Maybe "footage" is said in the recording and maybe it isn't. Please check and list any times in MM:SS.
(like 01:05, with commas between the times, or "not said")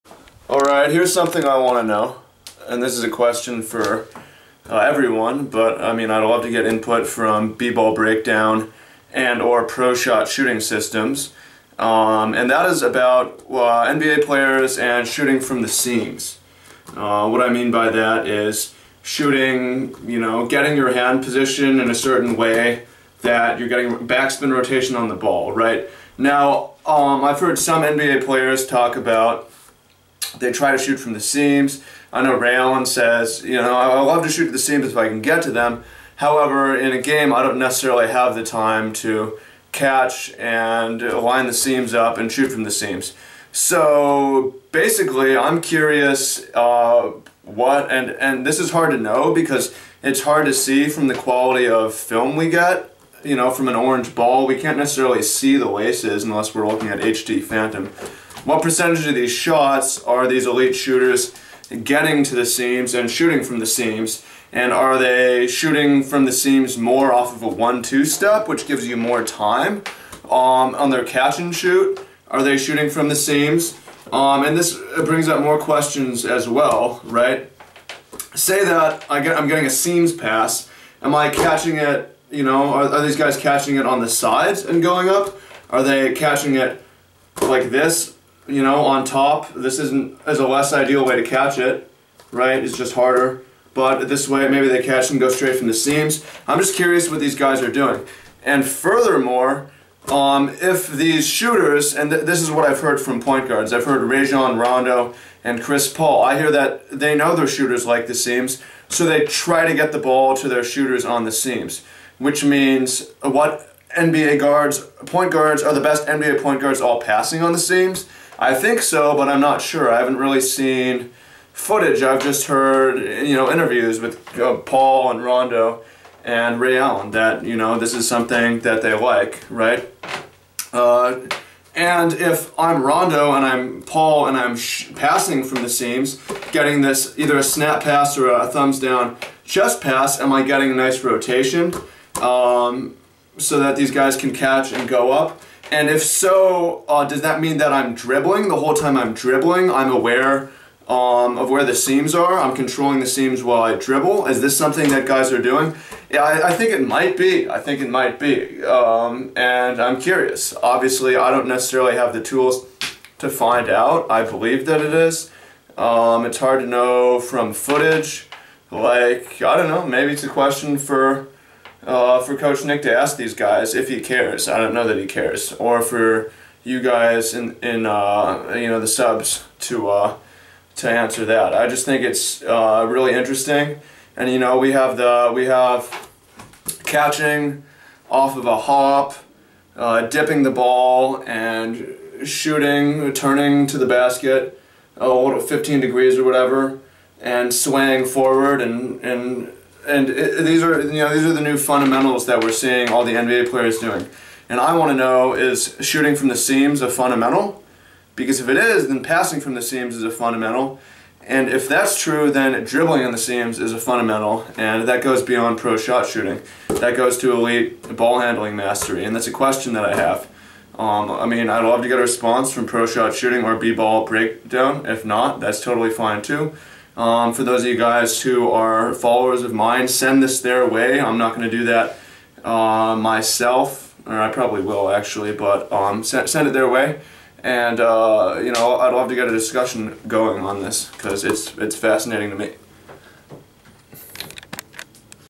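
02:01, 02:47.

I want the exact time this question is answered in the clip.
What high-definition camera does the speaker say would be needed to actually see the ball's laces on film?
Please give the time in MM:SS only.
00:56.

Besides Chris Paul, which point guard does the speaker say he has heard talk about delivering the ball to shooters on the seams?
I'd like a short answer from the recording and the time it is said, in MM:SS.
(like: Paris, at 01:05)
Rajon Rondo, at 01:44.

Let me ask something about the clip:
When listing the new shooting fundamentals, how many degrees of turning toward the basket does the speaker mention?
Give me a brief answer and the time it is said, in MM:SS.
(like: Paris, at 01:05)
15, at 03:15.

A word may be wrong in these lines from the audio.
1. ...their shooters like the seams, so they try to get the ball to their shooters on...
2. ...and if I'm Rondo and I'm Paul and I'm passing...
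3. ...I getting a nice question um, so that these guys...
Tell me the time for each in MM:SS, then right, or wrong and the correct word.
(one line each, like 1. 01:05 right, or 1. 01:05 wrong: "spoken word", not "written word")
1. 01:47 right
2. 02:11 right
3. 02:20 wrong: "rotation", not "question".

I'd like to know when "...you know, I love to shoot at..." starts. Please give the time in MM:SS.
00:33.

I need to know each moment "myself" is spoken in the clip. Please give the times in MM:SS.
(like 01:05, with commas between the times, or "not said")
03:52.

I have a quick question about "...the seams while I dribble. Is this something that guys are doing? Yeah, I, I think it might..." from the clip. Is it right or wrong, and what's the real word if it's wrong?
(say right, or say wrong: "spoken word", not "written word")
right.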